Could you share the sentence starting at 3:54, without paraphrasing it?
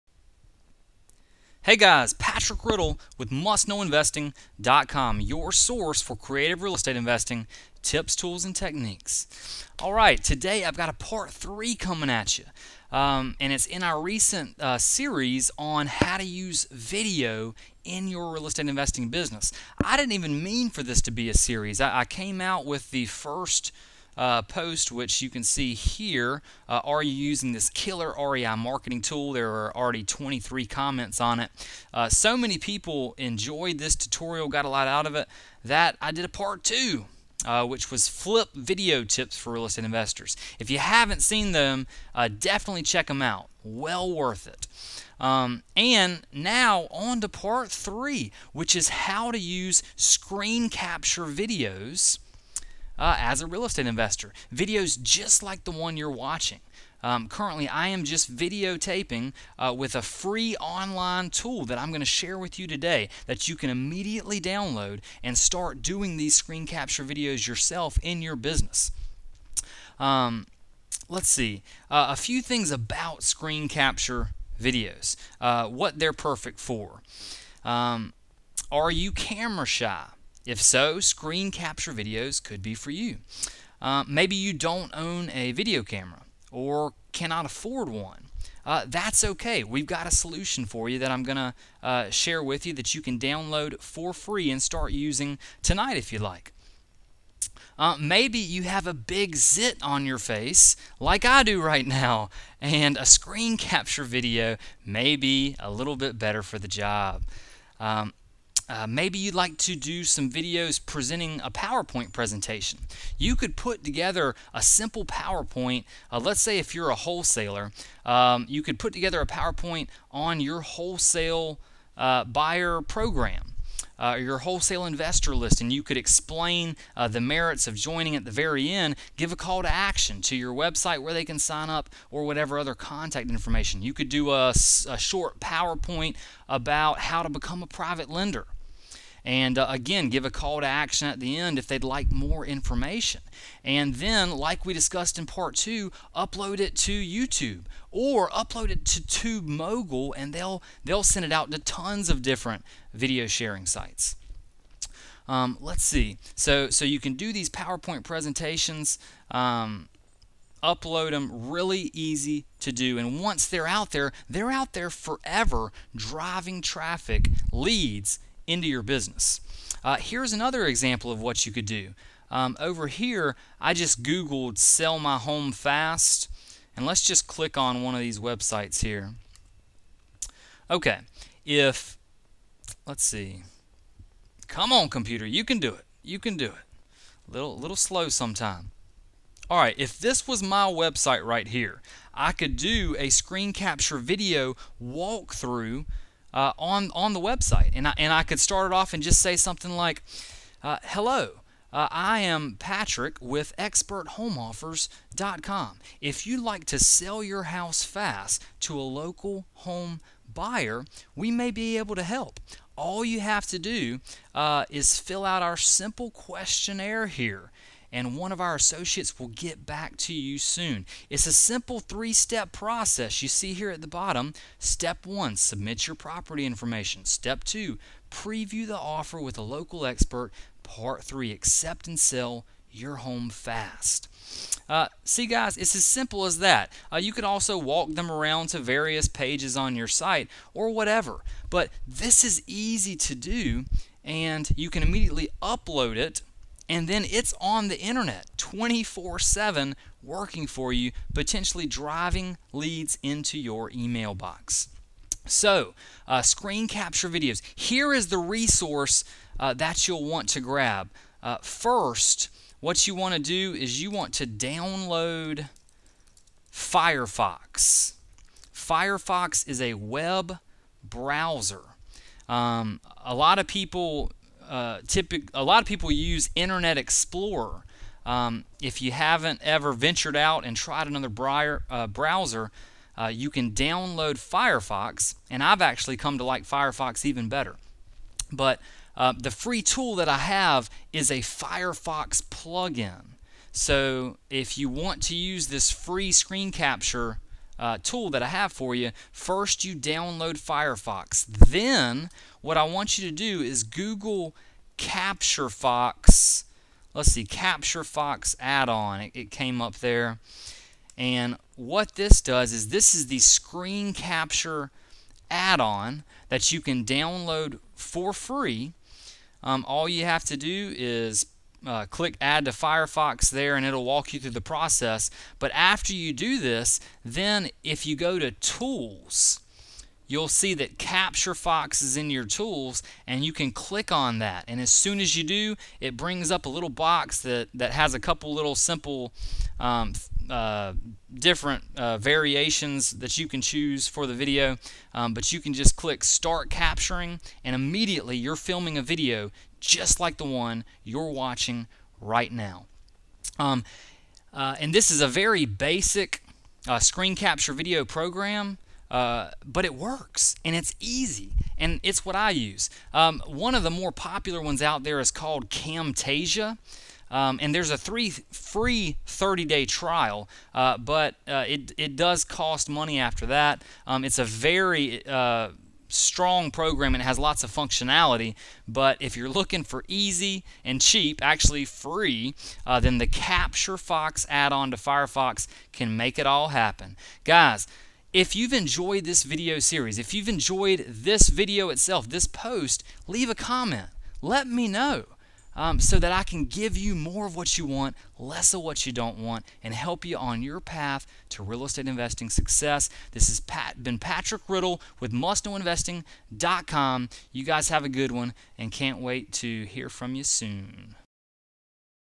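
Uh, see, guys, it's as simple as that.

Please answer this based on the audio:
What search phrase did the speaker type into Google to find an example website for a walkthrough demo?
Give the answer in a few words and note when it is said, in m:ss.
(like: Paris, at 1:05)
sell my home fast, at 2:54.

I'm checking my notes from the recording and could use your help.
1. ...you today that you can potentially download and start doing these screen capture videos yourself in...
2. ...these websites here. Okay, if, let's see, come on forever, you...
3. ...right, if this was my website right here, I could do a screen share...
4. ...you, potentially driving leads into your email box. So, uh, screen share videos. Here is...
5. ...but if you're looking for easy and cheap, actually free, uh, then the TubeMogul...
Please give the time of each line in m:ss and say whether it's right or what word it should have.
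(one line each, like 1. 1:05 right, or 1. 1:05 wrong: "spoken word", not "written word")
1. 1:02 wrong: "immediately", not "potentially"
2. 2:57 wrong: "computer", not "forever"
3. 3:09 wrong: "capture", not "share"
4. 4:10 wrong: "capture", not "share"
5. 6:18 wrong: "Capture", not "TubeMogul".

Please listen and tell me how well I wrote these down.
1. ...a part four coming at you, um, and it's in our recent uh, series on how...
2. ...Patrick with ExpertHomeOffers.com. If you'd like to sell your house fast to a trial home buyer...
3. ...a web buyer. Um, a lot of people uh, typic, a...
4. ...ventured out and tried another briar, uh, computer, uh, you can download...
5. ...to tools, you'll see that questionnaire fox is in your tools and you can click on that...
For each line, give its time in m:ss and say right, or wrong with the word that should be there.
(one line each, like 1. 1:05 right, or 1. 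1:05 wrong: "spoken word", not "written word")
1. 0:10 wrong: "three", not "four"
2. 3:22 wrong: "local", not "trial"
3. 4:29 wrong: "browser", not "buyer"
4. 4:39 wrong: "browser", not "computer"
5. 5:28 wrong: "capture", not "questionnaire".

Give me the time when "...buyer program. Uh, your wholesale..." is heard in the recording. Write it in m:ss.
2:02.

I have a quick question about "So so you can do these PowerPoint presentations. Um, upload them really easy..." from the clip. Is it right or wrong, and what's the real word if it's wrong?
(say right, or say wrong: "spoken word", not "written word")
right.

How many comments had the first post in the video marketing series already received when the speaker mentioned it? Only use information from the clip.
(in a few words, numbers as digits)
23.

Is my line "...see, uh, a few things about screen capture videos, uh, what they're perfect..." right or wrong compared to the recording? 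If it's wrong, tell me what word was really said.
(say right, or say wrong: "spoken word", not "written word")
right.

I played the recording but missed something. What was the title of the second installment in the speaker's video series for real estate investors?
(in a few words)
flip video tips for real estate investors.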